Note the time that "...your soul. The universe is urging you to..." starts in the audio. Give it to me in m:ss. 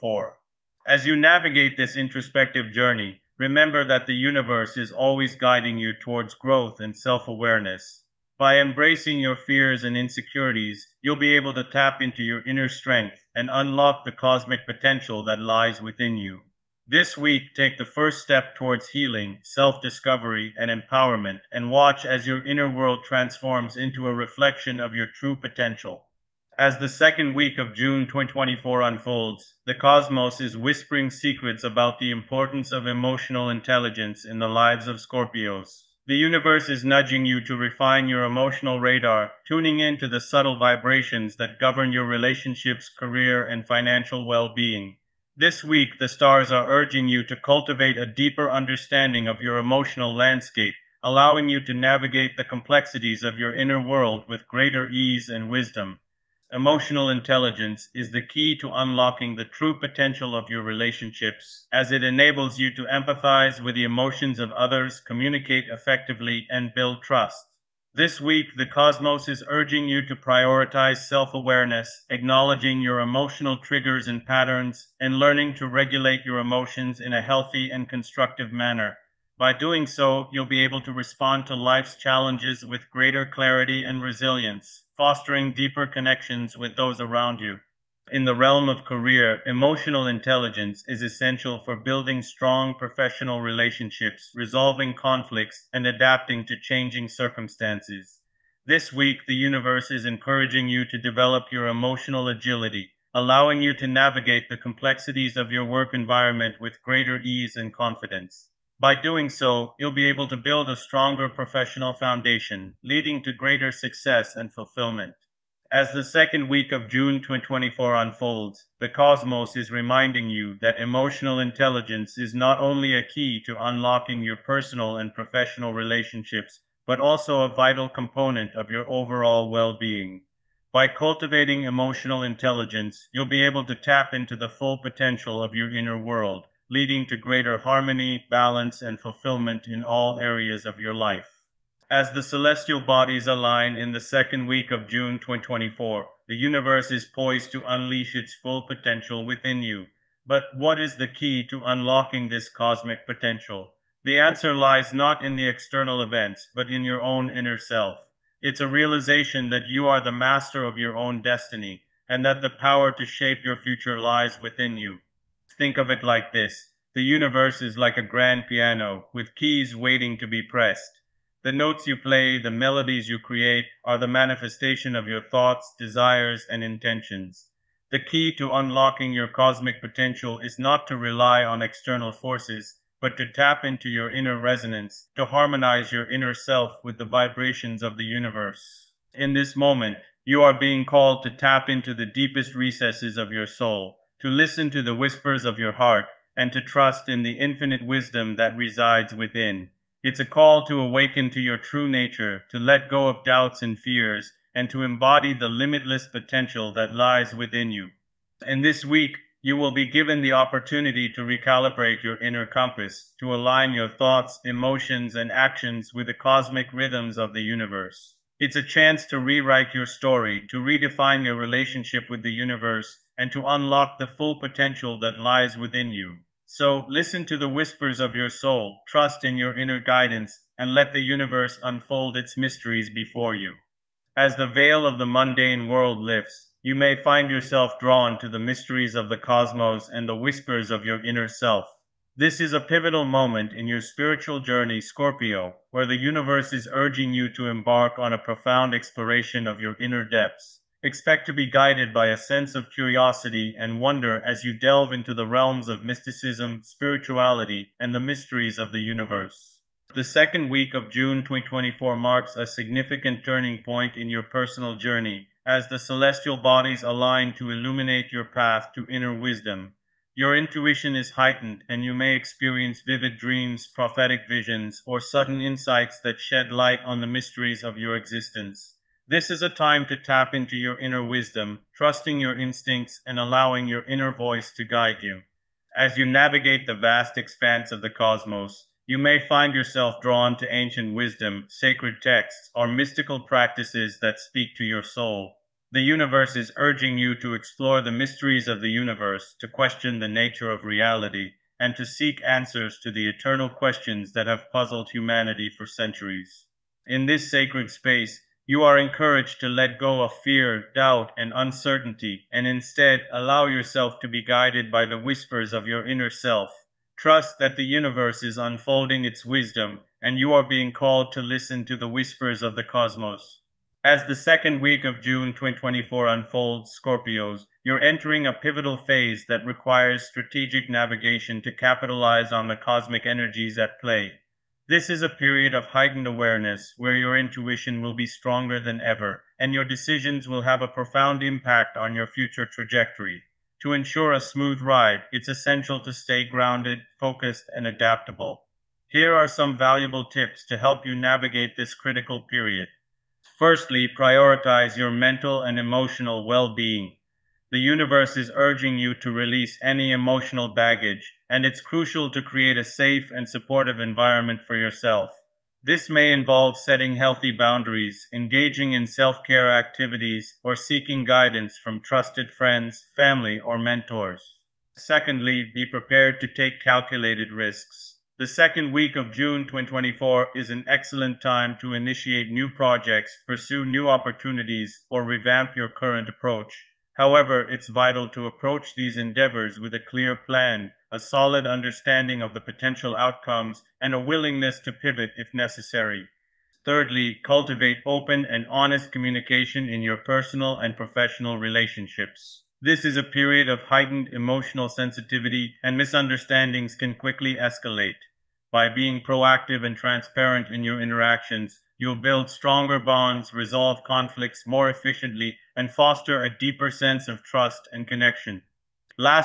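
4:54.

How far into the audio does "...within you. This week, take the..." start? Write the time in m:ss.
0:15.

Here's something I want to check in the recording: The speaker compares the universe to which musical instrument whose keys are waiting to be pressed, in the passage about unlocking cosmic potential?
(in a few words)
grand piano.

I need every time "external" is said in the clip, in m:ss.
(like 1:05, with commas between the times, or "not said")
2:35, 3:01.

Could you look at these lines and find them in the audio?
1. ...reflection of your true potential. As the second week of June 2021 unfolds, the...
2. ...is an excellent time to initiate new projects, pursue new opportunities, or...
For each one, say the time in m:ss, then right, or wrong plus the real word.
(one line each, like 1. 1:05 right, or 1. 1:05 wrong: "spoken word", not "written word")
1. 0:24 wrong: "2024", not "2021"
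2. 6:20 right.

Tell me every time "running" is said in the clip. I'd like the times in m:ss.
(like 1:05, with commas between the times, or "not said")
not said.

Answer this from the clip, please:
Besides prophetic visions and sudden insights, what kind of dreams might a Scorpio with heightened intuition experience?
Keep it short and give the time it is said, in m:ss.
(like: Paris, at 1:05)
vivid dreams, at 4:32.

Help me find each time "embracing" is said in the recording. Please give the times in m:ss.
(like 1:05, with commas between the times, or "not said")
0:08.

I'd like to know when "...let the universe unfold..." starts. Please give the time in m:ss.
3:50.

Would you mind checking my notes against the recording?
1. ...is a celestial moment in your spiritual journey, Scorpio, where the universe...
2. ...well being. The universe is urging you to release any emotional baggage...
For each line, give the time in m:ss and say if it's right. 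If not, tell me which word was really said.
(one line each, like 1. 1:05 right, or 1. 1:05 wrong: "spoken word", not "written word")
1. 4:02 wrong: "pivotal", not "celestial"
2. 5:56 right.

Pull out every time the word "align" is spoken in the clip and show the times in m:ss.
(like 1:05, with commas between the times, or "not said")
2:23, 3:33, 4:26.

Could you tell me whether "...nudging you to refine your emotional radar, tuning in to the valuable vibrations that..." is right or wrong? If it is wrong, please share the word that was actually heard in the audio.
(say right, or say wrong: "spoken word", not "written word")
wrong: "subtle", not "valuable".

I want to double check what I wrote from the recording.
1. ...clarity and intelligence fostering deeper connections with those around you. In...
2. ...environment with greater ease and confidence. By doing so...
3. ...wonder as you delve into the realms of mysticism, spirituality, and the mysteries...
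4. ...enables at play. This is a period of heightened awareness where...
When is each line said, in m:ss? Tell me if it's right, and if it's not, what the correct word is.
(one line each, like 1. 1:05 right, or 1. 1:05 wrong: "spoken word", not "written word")
1. 1:23 wrong: "resilience", not "intelligence"
2. 1:45 right
3. 4:13 right
4. 5:33 wrong: "energies", not "enables".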